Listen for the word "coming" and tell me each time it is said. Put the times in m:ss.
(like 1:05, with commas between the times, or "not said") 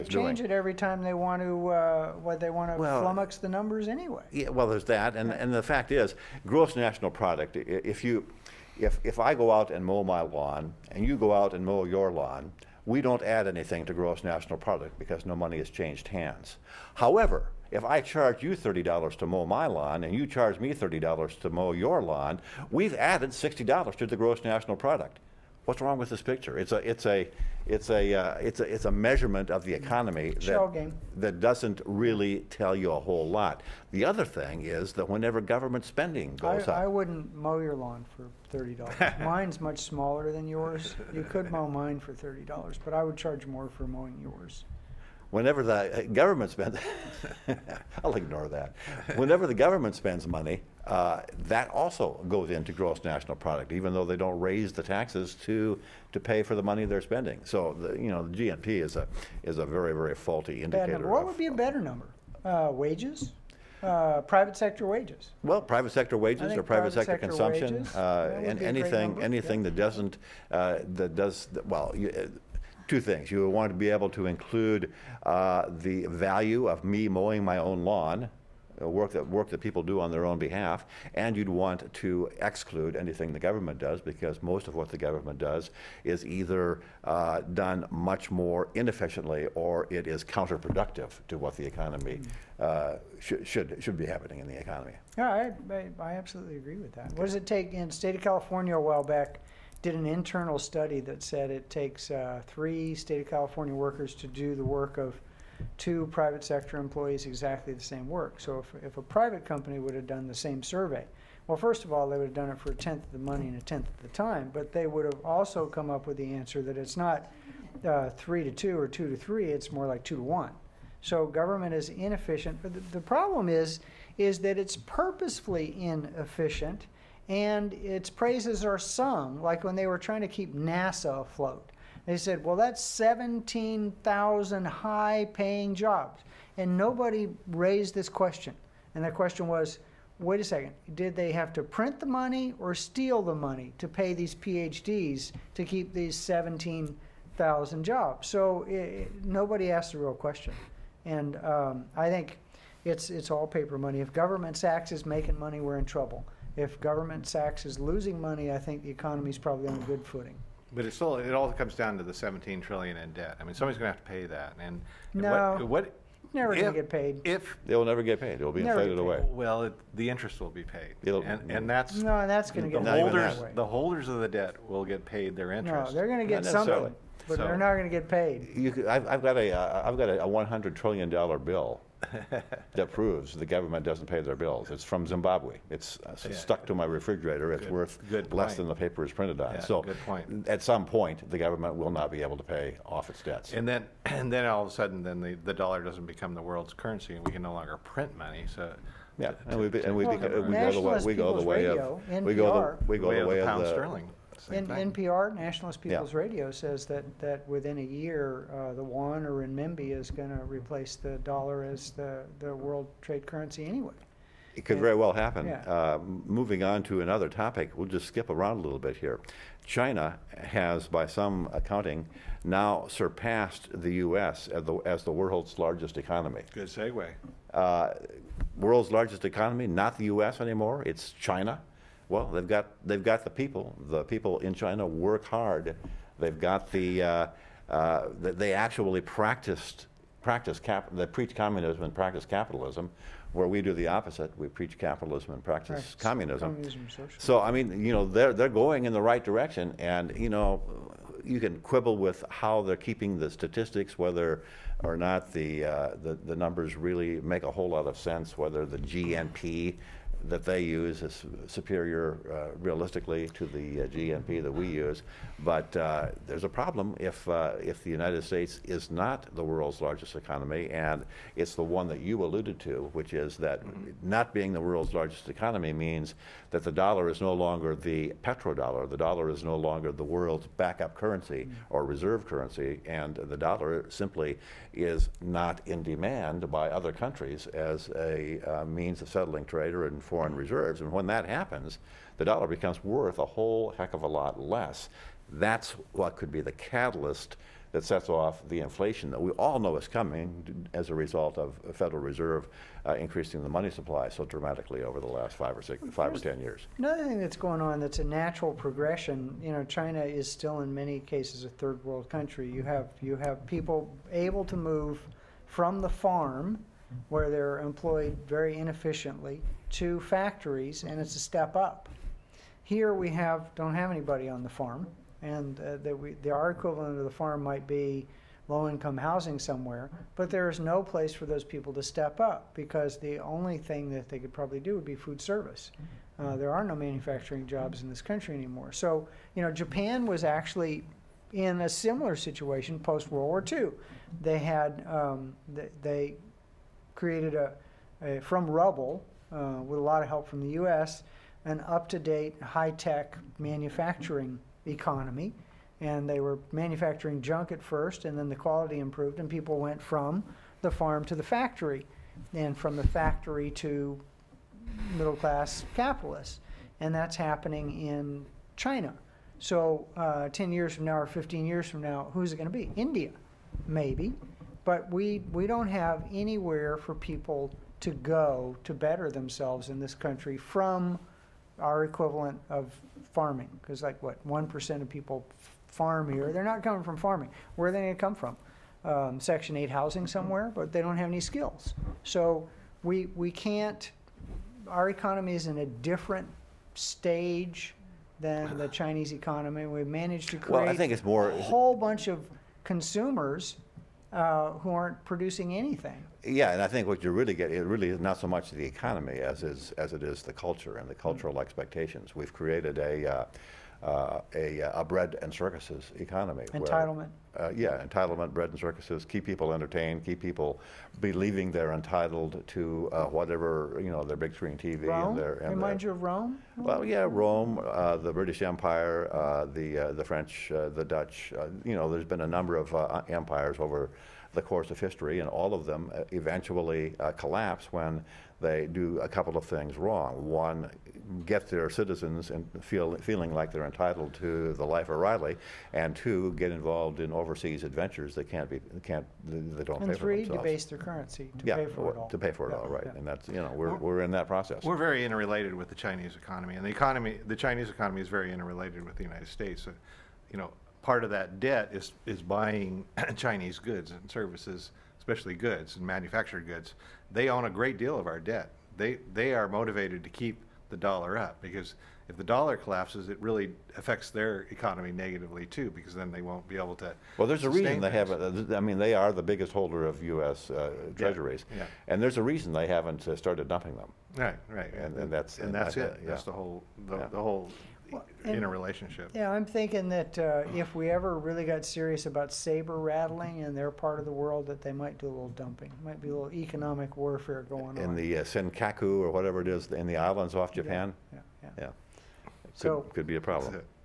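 4:59, 6:26.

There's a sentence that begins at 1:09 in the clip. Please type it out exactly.
that doesn't uh, that does well.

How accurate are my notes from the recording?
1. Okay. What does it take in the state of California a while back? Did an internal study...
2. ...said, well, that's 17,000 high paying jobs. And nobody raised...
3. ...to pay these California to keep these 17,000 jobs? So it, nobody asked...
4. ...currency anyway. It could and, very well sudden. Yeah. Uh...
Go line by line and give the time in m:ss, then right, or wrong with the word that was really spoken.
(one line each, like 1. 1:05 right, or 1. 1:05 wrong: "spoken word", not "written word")
1. 1:37 right
2. 2:12 right
3. 2:23 wrong: "PhDs", not "California"
4. 3:33 wrong: "happen", not "sudden".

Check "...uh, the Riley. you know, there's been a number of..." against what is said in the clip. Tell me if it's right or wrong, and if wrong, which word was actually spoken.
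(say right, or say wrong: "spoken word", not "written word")
wrong: "Dutch", not "Riley".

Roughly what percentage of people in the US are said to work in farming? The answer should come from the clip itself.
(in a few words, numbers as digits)
1%.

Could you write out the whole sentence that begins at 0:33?
The other thing is that whenever government spending goes up, I wouldn't mow your lawn for thirty dollars.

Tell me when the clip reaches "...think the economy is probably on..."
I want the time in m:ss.
2:38.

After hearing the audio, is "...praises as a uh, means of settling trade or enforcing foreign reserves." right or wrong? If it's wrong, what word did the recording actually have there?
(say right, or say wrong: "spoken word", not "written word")
wrong: "countries", not "praises".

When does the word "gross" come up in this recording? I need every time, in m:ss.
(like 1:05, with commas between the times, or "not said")
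0:06, 0:13, 0:24, 0:52.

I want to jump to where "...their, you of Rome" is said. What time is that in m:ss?
7:05.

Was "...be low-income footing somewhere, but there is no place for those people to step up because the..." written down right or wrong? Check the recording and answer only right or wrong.
wrong.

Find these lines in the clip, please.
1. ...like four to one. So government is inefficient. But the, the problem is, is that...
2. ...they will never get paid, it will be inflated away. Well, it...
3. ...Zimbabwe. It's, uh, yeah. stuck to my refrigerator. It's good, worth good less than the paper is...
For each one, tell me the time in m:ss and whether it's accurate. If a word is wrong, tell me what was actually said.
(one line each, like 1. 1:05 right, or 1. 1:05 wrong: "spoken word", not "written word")
1. 1:59 wrong: "two", not "four"
2. 2:47 right
3. 3:05 right.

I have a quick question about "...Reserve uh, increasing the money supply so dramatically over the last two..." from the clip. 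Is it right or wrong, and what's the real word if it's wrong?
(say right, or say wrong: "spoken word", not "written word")
wrong: "five", not "two".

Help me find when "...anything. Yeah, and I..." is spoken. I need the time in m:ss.
6:45.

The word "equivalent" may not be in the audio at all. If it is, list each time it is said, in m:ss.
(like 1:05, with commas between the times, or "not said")
5:26, 6:21.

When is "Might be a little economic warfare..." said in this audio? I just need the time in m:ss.
8:15.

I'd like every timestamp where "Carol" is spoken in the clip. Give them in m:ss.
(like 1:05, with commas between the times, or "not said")
not said.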